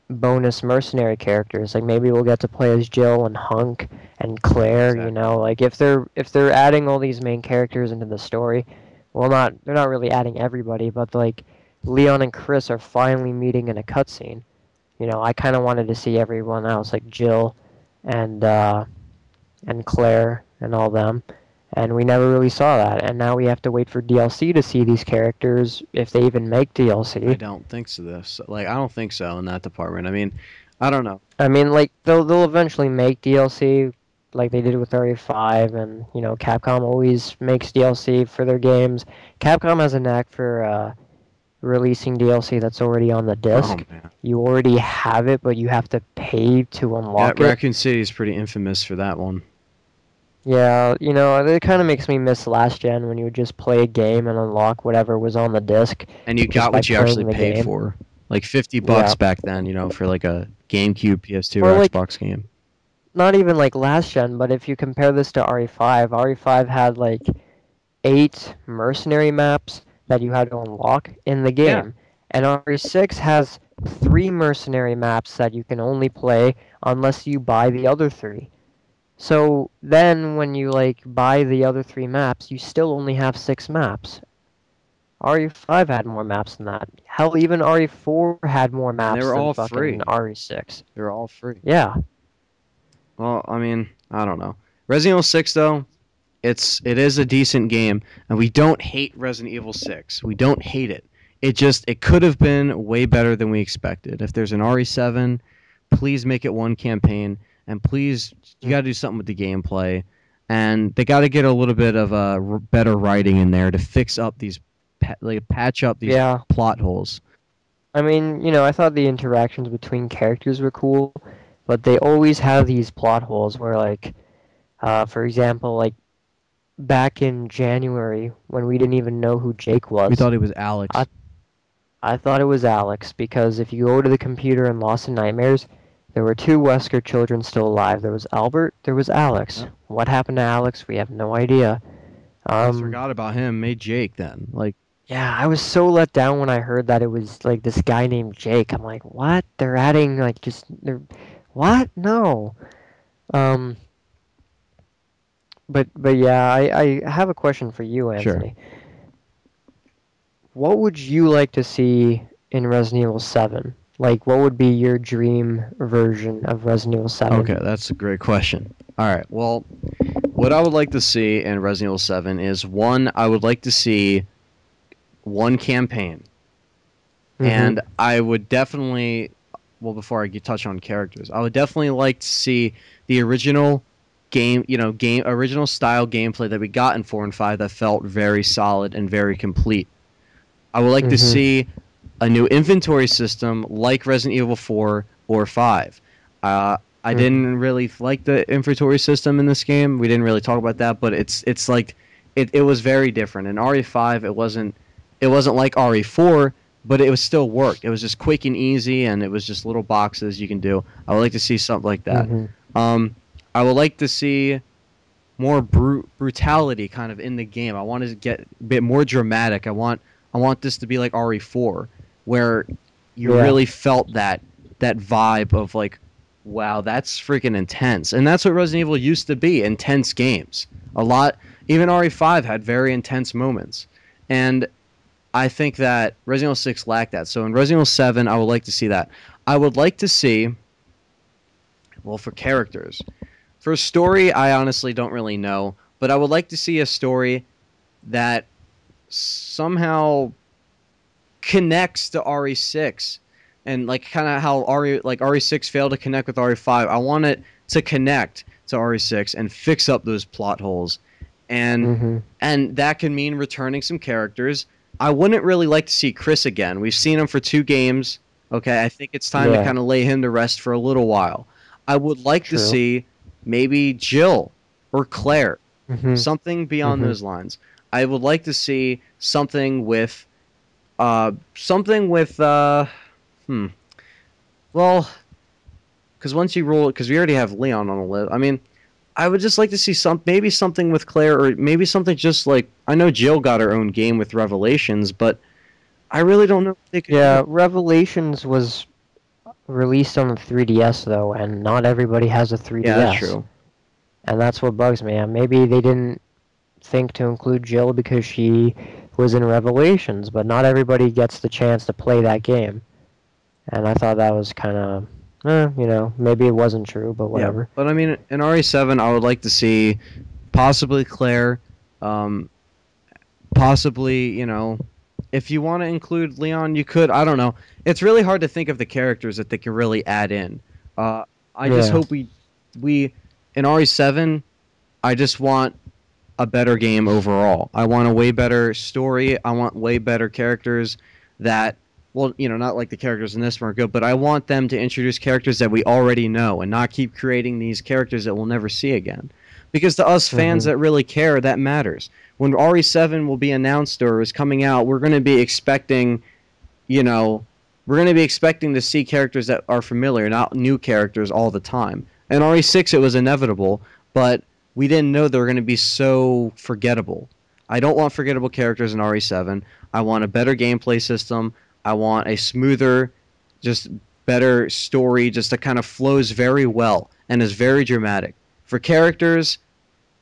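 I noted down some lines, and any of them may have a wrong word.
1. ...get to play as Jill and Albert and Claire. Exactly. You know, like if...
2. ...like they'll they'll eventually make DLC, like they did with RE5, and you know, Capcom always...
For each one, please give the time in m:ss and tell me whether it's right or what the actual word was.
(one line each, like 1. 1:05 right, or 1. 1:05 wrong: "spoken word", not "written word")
1. 0:02 wrong: "Hunk", not "Albert"
2. 0:31 right.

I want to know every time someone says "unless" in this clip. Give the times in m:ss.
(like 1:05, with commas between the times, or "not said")
1:16.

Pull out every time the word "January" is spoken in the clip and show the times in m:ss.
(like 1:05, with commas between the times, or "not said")
2:07.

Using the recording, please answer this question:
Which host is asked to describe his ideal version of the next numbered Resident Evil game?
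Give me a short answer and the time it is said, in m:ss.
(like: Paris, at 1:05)
Anthony, at 2:38.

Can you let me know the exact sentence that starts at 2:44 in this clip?
like what would be your dream version of Resident Evil 7?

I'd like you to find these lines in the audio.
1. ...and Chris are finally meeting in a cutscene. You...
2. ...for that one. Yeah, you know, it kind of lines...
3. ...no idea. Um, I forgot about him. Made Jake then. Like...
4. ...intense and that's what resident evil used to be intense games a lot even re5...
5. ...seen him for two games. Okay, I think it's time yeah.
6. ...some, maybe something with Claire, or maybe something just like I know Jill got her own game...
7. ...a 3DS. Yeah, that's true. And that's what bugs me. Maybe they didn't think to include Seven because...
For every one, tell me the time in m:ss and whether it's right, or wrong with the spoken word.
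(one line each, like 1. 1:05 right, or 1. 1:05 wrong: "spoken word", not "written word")
1. 0:12 right
2. 0:48 wrong: "makes", not "lines"
3. 2:21 right
4. 3:47 right
5. 4:26 right
6. 4:49 right
7. 5:02 wrong: "Jill", not "Seven".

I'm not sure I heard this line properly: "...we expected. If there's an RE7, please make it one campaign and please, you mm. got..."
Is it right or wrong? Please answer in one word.
right.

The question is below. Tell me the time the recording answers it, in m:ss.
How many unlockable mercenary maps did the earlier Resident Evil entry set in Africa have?
1:08.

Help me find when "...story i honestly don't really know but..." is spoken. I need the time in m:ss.
4:03.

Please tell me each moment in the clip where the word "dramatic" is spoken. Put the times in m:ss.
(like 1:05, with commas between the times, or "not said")
3:39, 6:17.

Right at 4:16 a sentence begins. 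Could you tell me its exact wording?
I want it to connect to RE6 and fix up those plot holes.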